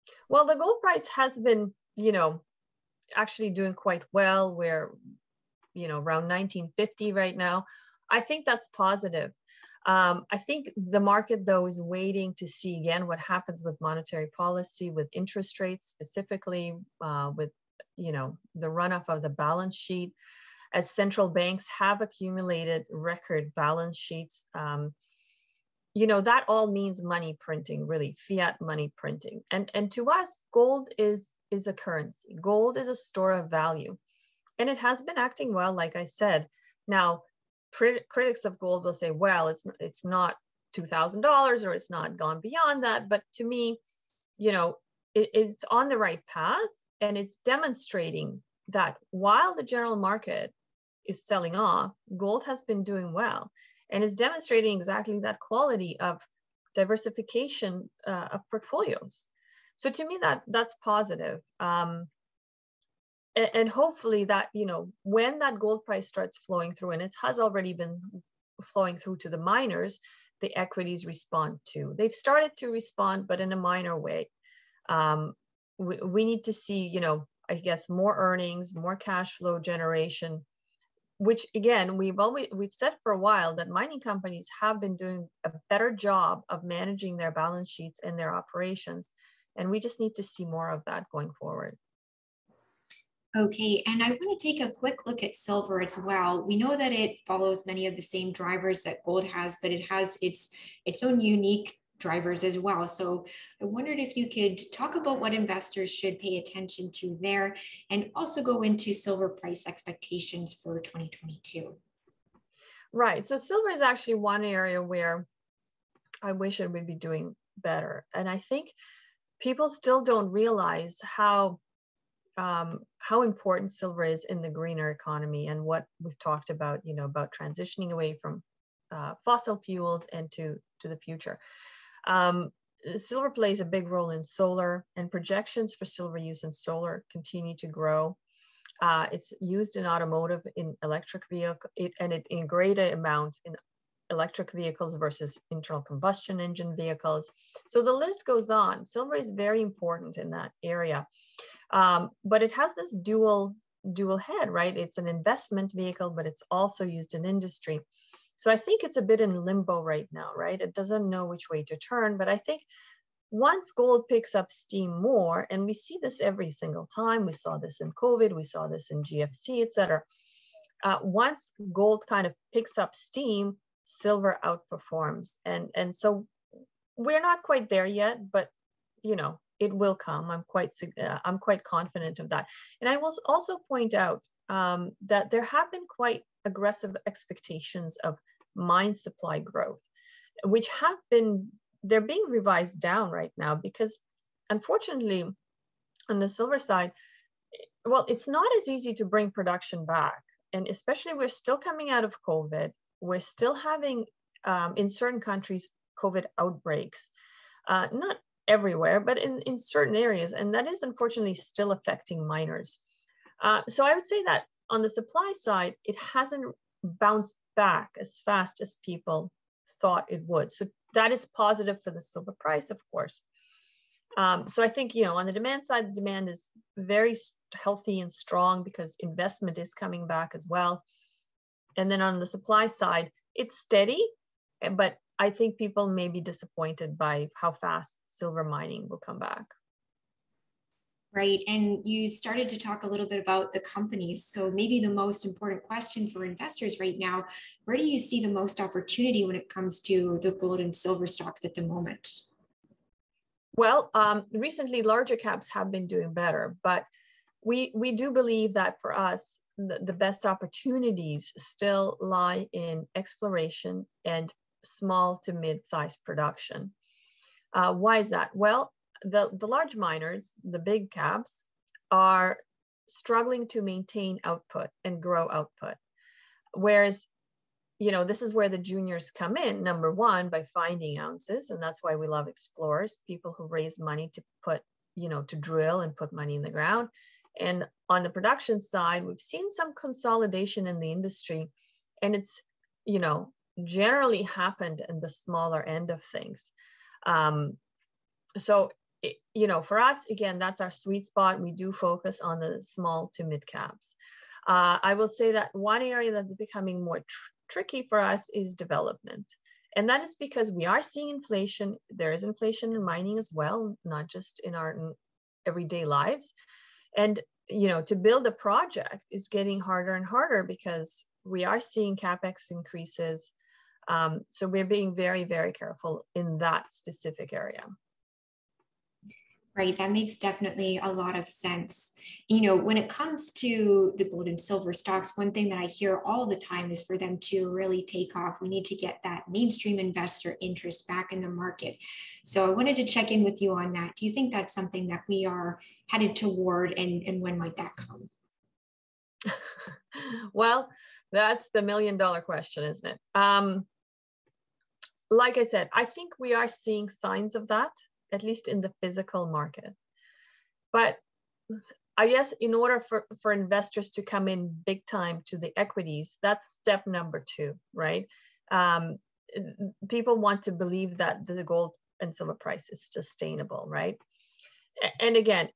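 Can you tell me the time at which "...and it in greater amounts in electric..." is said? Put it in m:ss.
2:21.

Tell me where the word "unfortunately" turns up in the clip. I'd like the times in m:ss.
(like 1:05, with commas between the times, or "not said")
3:14, 3:30.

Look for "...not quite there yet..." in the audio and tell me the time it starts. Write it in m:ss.
2:57.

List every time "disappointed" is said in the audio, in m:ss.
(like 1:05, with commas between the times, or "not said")
3:56.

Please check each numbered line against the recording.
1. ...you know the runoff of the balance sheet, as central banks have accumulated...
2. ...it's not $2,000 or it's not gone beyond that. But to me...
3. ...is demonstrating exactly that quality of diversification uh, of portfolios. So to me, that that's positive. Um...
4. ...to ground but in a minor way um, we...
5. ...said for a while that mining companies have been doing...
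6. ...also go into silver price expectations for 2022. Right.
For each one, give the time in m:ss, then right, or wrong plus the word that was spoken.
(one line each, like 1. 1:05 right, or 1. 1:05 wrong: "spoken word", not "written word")
1. 0:17 right
2. 0:39 right
3. 0:54 right
4. 1:12 wrong: "respond", not "ground"
5. 1:22 right
6. 1:48 right.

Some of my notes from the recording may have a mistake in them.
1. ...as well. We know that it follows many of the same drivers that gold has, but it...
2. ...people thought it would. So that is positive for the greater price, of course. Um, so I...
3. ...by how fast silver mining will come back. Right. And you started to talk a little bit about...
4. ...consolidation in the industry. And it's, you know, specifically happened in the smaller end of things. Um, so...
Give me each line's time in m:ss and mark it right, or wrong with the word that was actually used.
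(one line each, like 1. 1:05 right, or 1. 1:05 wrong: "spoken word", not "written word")
1. 1:35 right
2. 3:38 wrong: "silver", not "greater"
3. 3:56 right
4. 4:49 wrong: "generally", not "specifically".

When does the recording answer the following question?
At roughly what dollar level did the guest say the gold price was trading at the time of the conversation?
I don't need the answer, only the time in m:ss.
0:06.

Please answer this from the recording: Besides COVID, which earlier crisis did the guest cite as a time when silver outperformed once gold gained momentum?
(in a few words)
GFC.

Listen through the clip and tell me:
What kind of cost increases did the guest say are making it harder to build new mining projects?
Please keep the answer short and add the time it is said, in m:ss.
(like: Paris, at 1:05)
capex increases, at 5:21.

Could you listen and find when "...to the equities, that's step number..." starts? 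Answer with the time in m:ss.
6:05.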